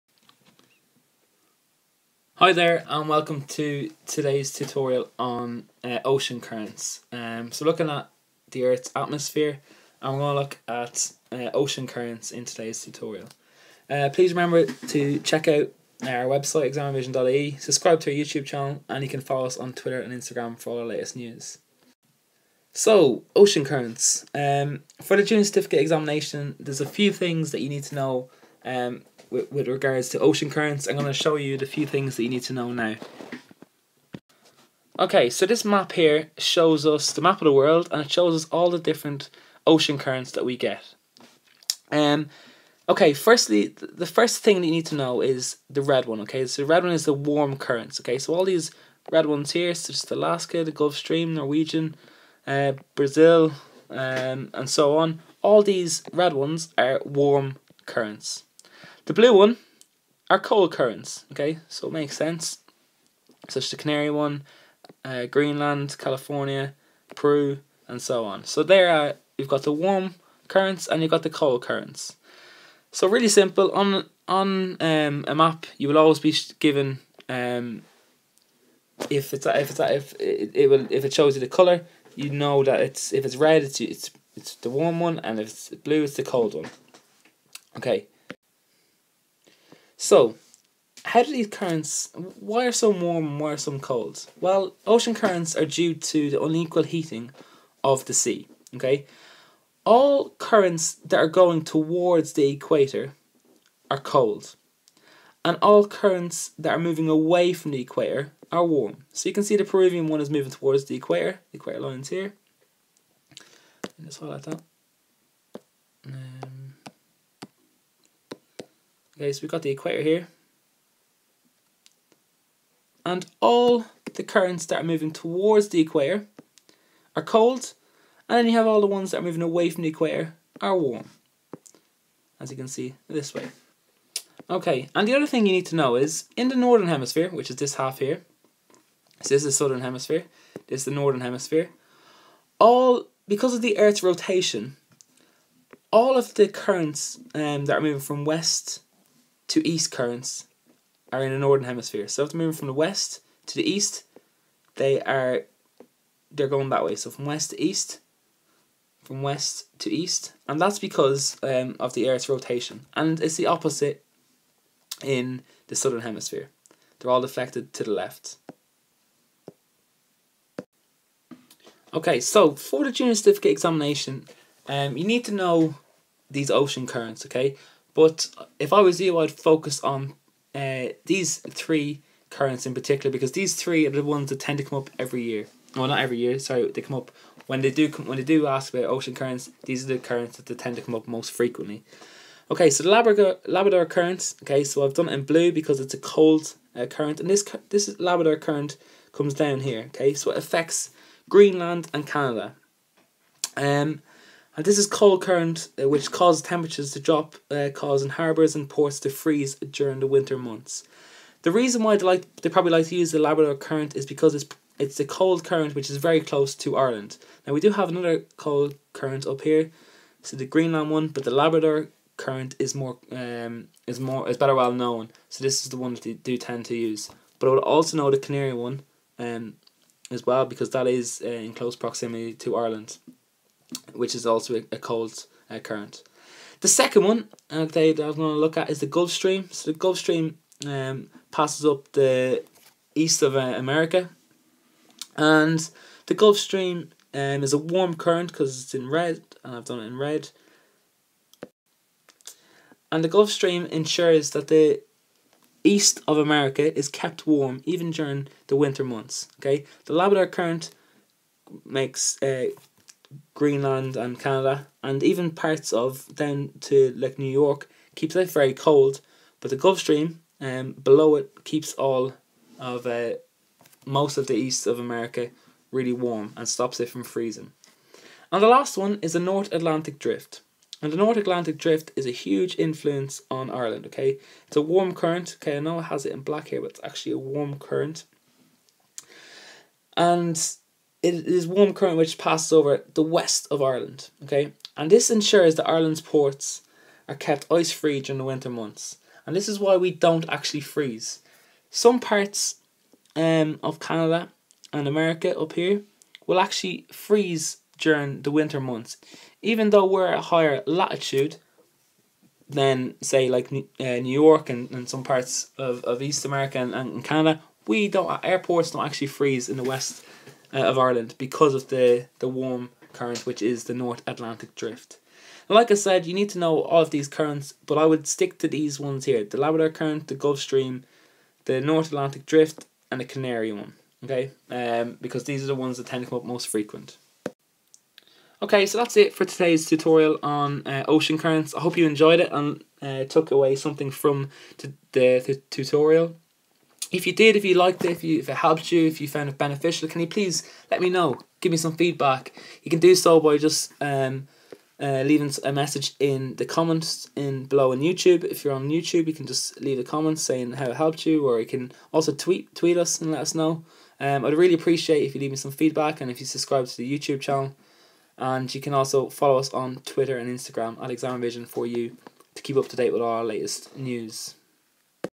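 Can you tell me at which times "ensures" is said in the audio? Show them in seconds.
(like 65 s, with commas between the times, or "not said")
253 s, 295 s.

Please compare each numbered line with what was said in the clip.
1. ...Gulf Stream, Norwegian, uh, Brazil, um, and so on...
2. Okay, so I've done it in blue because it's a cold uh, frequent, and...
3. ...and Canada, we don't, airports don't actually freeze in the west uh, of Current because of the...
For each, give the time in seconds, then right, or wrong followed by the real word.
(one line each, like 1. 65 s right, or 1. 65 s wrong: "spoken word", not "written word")
1. 50 s right
2. 194 s wrong: "current", not "frequent"
3. 316 s wrong: "Ireland", not "Current".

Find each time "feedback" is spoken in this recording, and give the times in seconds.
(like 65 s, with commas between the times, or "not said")
351 s, 365 s.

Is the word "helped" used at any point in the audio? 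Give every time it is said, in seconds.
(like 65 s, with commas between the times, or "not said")
348 s, 360 s.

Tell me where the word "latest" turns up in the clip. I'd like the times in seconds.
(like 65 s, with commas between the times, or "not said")
20 s, 373 s.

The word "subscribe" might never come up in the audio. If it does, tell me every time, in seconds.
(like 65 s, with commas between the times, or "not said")
17 s, 366 s.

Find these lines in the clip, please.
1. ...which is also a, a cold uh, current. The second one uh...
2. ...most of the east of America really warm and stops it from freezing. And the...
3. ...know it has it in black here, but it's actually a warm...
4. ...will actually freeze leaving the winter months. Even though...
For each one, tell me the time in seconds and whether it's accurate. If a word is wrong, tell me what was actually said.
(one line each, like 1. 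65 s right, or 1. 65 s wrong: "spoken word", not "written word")
1. 233 s right
2. 273 s right
3. 285 s right
4. 306 s wrong: "during", not "leaving".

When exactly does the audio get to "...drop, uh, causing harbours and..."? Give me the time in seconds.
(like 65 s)
206 s.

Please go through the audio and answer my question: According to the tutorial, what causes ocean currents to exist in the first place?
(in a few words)
Unequal heating of the sea.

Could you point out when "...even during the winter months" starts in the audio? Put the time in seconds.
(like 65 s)
257 s.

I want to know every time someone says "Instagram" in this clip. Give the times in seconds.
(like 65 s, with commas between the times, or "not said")
20 s, 370 s.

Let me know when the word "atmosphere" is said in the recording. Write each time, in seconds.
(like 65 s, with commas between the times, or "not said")
8 s.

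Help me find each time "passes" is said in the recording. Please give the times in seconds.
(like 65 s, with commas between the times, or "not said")
241 s, 292 s.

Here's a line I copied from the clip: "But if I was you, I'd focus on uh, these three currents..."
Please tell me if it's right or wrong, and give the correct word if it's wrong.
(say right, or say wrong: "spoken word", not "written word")
right.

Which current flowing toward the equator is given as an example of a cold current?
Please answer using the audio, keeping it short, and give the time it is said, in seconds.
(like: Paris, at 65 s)
Peruvian, at 109 s.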